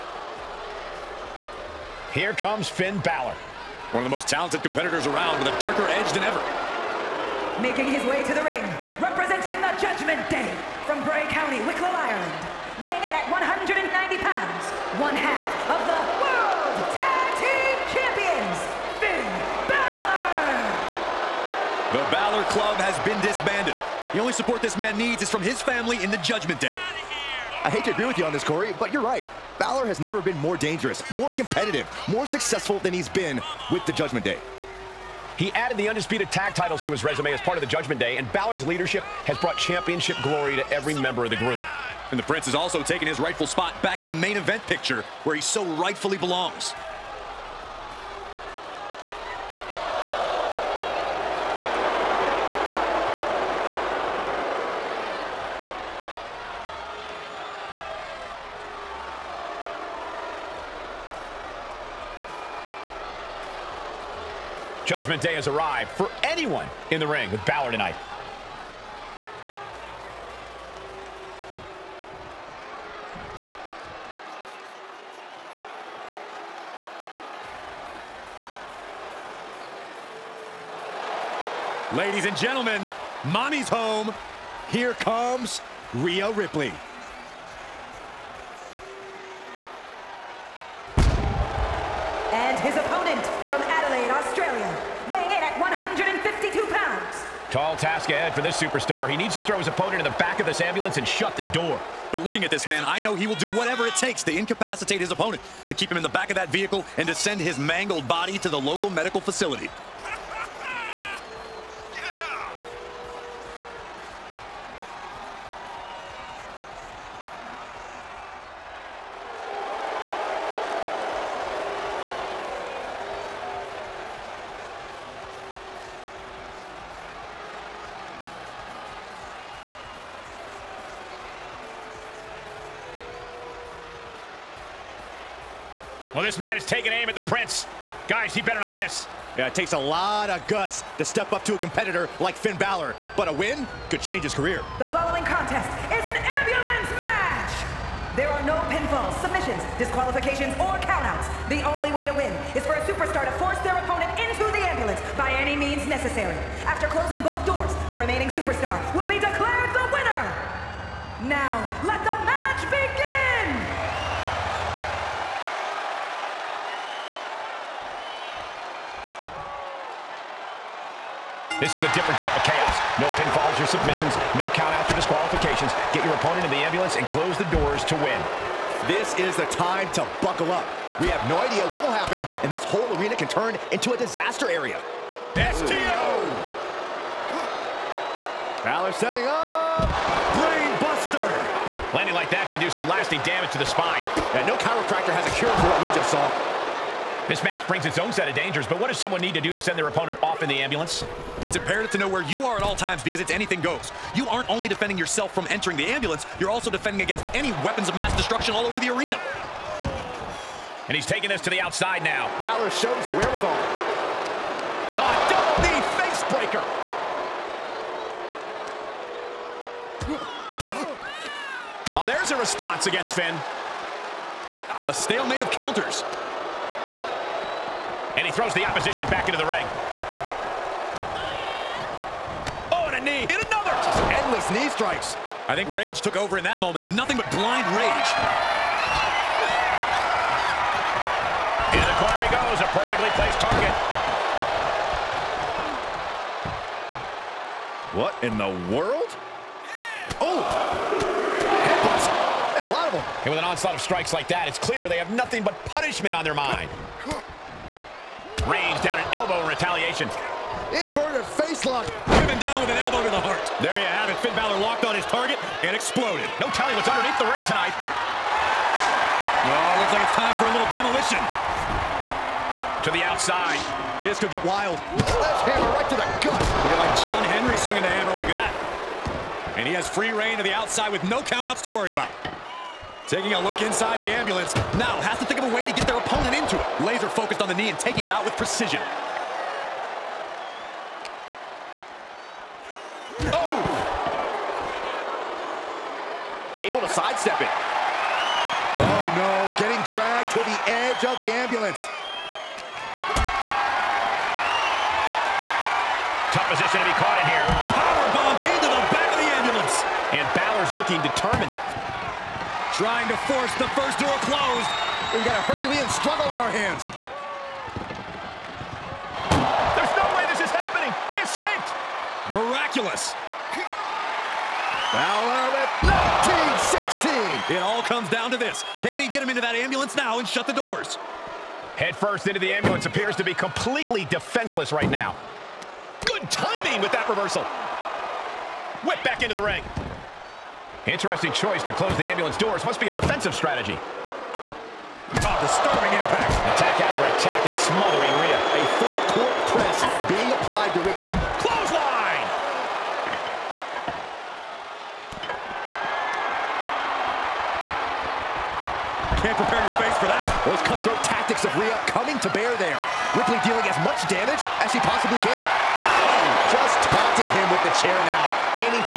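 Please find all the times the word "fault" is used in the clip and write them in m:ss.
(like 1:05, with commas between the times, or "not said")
not said.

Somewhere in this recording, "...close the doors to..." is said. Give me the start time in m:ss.
2:57.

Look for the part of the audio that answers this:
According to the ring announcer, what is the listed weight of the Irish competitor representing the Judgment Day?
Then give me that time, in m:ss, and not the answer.
0:13.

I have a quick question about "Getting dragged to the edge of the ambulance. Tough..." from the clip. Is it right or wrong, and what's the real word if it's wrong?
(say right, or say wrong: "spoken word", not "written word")
right.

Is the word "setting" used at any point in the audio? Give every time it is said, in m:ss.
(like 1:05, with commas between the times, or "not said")
3:08.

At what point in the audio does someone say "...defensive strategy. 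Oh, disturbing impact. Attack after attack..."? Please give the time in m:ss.
5:42.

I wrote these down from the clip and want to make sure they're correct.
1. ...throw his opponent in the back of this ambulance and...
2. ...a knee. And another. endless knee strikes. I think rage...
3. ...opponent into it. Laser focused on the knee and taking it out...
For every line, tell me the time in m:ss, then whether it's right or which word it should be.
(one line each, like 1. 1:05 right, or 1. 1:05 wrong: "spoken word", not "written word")
1. 1:39 right
2. 3:52 right
3. 4:45 right.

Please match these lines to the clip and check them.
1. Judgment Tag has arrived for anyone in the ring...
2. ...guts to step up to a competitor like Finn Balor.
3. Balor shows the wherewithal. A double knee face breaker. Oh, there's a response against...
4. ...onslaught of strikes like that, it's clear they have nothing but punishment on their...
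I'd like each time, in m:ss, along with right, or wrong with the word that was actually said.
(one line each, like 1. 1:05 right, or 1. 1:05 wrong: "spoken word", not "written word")
1. 1:04 wrong: "Day", not "Tag"
2. 2:20 right
3. 3:32 right
4. 4:13 right.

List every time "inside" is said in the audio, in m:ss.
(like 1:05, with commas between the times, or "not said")
4:43.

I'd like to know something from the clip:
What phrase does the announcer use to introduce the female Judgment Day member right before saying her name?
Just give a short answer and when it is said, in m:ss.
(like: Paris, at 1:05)
Mommy's home, at 1:23.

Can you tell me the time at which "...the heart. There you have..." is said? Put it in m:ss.
4:23.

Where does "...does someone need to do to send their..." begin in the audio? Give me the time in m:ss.
3:18.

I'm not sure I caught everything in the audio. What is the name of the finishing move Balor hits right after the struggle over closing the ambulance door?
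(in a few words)
1916.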